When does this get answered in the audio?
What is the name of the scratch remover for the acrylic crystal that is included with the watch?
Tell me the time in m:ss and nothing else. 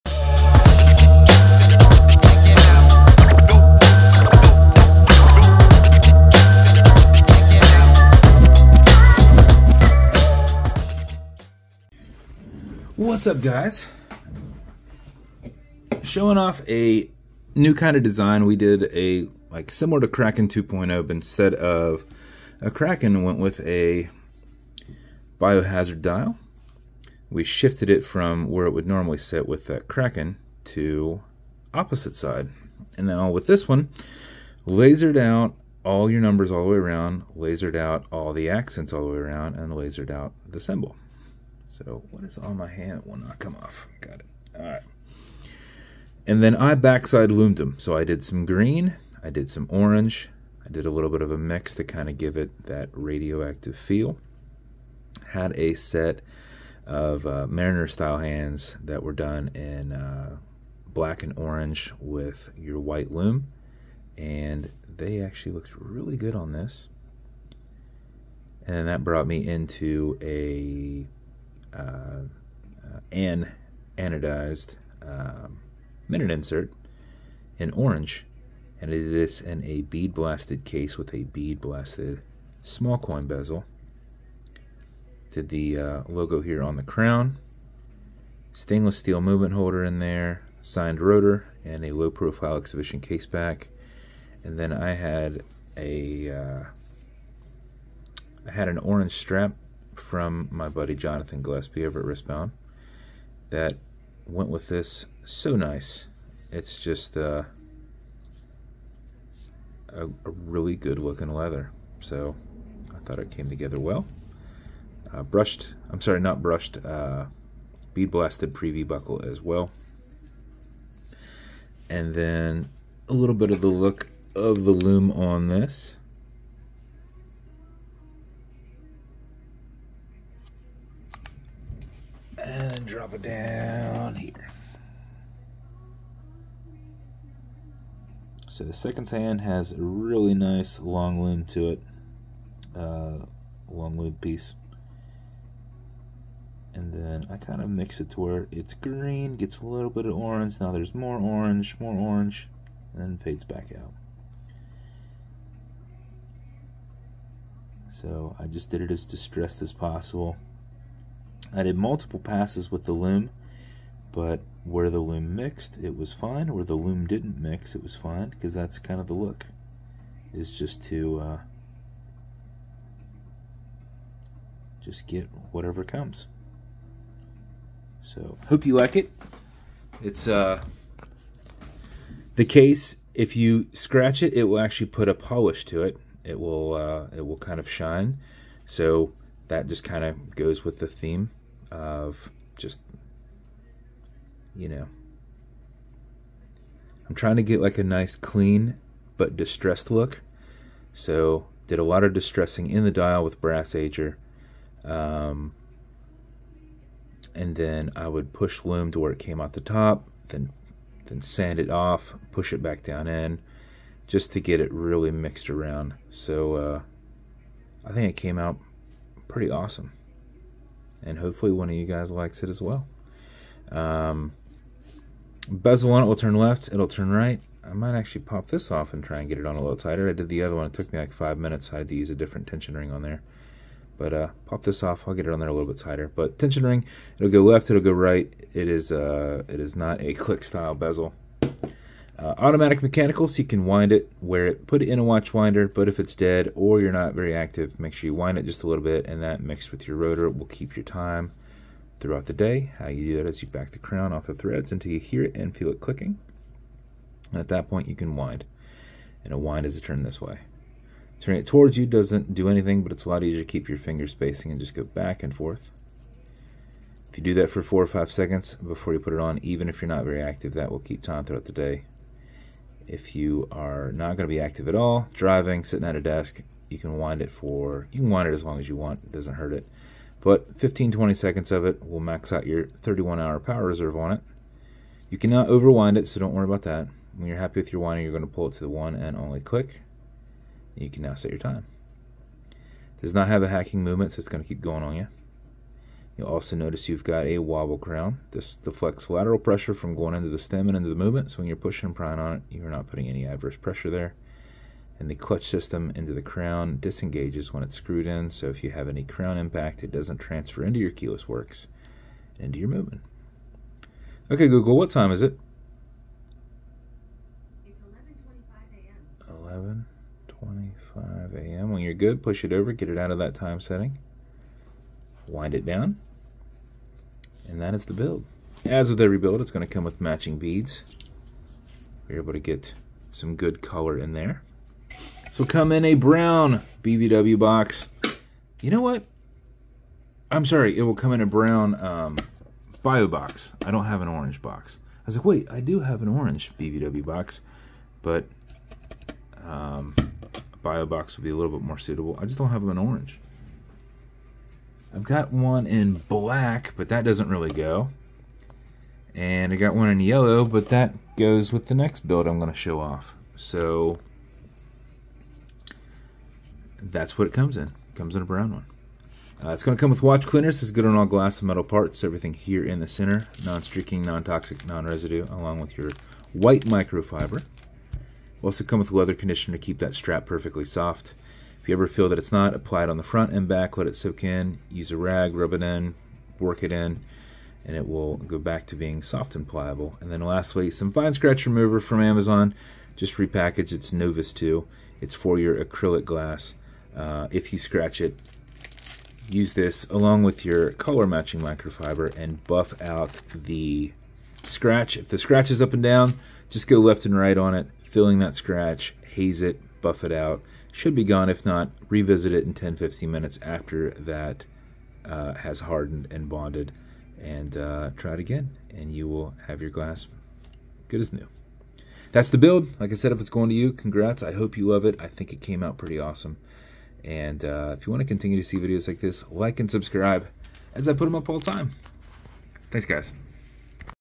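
6:33.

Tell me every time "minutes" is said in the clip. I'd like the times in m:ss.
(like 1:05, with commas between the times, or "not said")
1:16, 3:51, 6:53.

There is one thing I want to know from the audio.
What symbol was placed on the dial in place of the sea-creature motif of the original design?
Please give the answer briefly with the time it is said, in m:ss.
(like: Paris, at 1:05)
Biohazard, at 0:25.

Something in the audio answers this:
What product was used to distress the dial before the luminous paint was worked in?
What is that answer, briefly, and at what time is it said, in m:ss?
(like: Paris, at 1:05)
Brass ager, at 3:23.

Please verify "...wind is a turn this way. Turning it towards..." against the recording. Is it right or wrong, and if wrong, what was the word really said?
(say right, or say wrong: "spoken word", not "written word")
right.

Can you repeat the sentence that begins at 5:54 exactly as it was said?
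I've got one in black, but that doesn't really go.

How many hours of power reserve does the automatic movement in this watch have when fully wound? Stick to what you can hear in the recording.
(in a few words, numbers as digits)
31.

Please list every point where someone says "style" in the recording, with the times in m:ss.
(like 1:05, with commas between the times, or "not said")
0:57, 4:00.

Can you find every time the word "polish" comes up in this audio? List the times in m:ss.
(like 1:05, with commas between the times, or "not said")
3:05.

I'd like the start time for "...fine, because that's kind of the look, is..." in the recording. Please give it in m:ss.
2:47.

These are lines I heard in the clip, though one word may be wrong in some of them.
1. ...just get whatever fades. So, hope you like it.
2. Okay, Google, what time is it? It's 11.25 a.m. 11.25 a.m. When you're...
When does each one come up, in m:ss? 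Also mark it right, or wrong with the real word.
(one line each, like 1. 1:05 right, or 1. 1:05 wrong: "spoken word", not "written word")
1. 2:54 wrong: "comes", not "fades"
2. 5:14 right.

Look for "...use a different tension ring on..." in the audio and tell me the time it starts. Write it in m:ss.
3:51.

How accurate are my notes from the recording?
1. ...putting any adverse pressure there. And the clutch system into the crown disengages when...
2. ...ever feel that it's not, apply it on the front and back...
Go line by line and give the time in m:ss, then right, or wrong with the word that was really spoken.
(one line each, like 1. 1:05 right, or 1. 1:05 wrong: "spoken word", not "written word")
1. 5:02 right
2. 6:21 right.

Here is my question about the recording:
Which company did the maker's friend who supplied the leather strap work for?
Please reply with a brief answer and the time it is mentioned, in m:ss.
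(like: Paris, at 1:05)
Wristbound, at 1:42.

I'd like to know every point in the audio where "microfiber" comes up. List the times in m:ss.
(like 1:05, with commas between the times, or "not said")
6:16, 6:41.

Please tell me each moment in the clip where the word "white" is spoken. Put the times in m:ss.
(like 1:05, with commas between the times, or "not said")
1:02, 6:16.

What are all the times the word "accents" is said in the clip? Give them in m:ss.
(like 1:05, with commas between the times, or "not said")
0:38.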